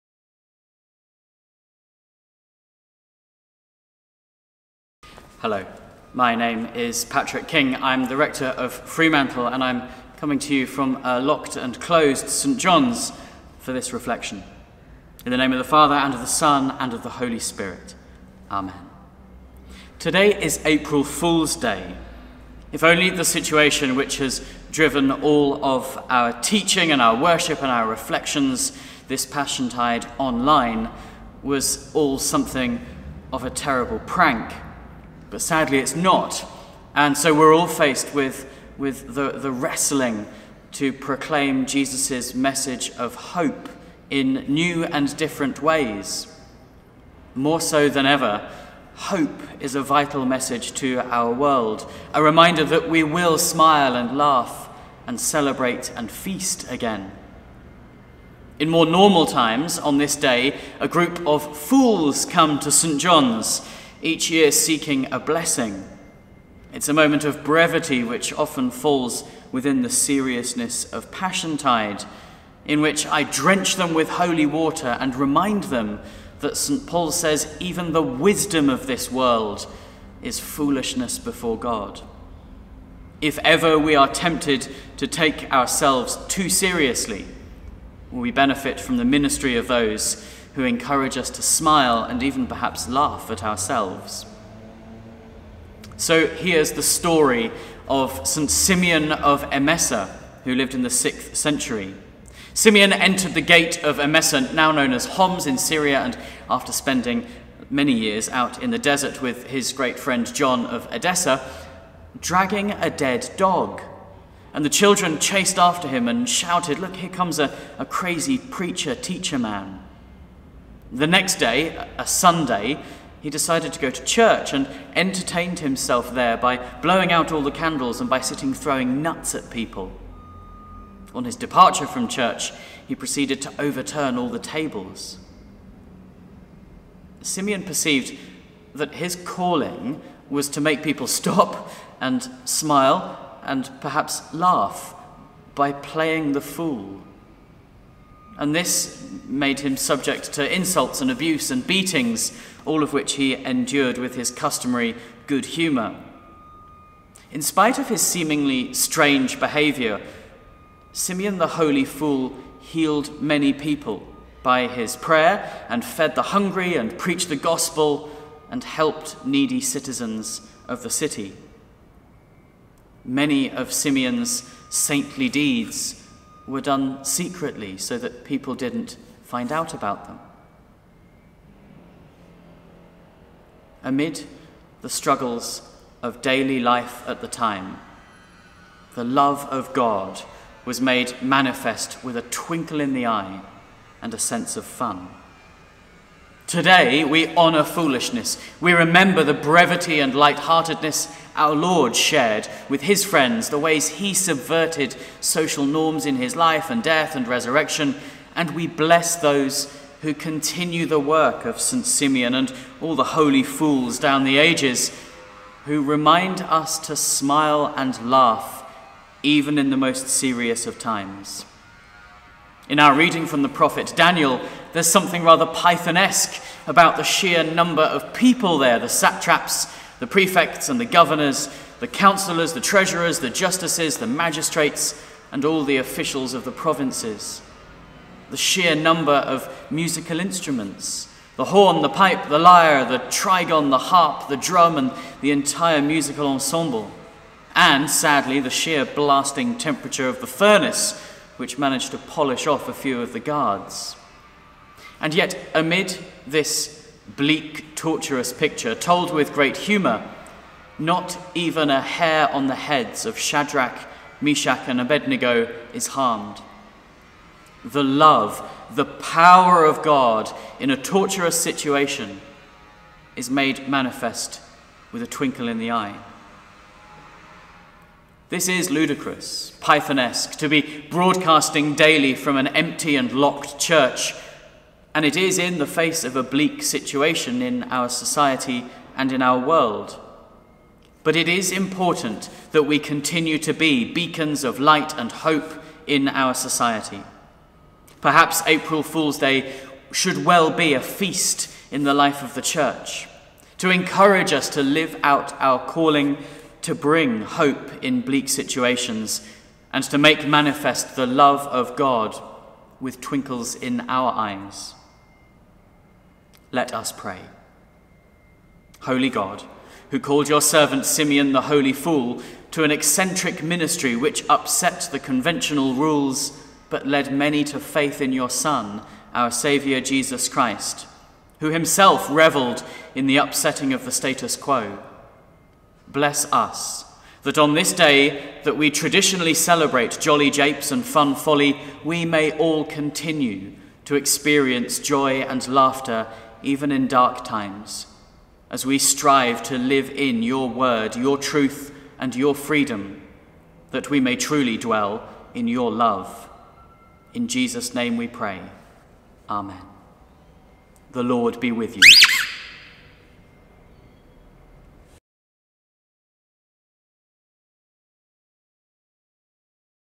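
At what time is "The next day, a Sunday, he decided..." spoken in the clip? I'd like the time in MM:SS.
02:00.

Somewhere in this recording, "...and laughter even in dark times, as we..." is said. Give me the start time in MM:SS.
05:45.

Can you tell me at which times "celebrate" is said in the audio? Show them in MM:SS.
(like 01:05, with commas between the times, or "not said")
00:55, 05:39.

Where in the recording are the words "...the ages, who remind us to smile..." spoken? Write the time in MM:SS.
03:34.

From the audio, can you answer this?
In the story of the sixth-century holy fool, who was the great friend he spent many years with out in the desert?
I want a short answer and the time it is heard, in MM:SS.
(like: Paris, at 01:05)
John of Edessa, at 01:50.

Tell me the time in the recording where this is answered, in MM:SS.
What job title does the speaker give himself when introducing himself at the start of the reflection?
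00:08.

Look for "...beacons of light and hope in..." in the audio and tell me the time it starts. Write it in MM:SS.
04:53.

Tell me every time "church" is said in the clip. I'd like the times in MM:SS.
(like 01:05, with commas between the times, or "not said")
02:04, 02:12, 04:43, 05:02.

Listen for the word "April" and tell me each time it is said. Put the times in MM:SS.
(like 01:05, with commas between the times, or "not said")
00:20, 04:58.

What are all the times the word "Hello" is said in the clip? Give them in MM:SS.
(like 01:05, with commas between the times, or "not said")
00:05.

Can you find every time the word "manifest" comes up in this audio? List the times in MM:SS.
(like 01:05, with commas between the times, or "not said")
03:11, 04:33, 05:10.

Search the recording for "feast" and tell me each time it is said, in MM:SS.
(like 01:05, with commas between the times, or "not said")
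00:56, 05:00.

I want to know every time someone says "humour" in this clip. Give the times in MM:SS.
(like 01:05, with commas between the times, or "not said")
02:35, 04:19.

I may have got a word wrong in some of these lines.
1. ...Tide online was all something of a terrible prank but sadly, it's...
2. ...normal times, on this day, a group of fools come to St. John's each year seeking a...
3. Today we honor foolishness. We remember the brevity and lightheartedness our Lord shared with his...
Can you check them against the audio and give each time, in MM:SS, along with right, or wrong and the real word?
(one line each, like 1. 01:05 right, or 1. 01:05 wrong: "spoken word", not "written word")
1. 00:29 right
2. 00:58 right
3. 03:16 right.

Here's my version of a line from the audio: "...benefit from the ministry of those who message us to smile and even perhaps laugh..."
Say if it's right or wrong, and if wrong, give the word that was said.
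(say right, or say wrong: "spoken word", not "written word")
wrong: "encourage", not "message".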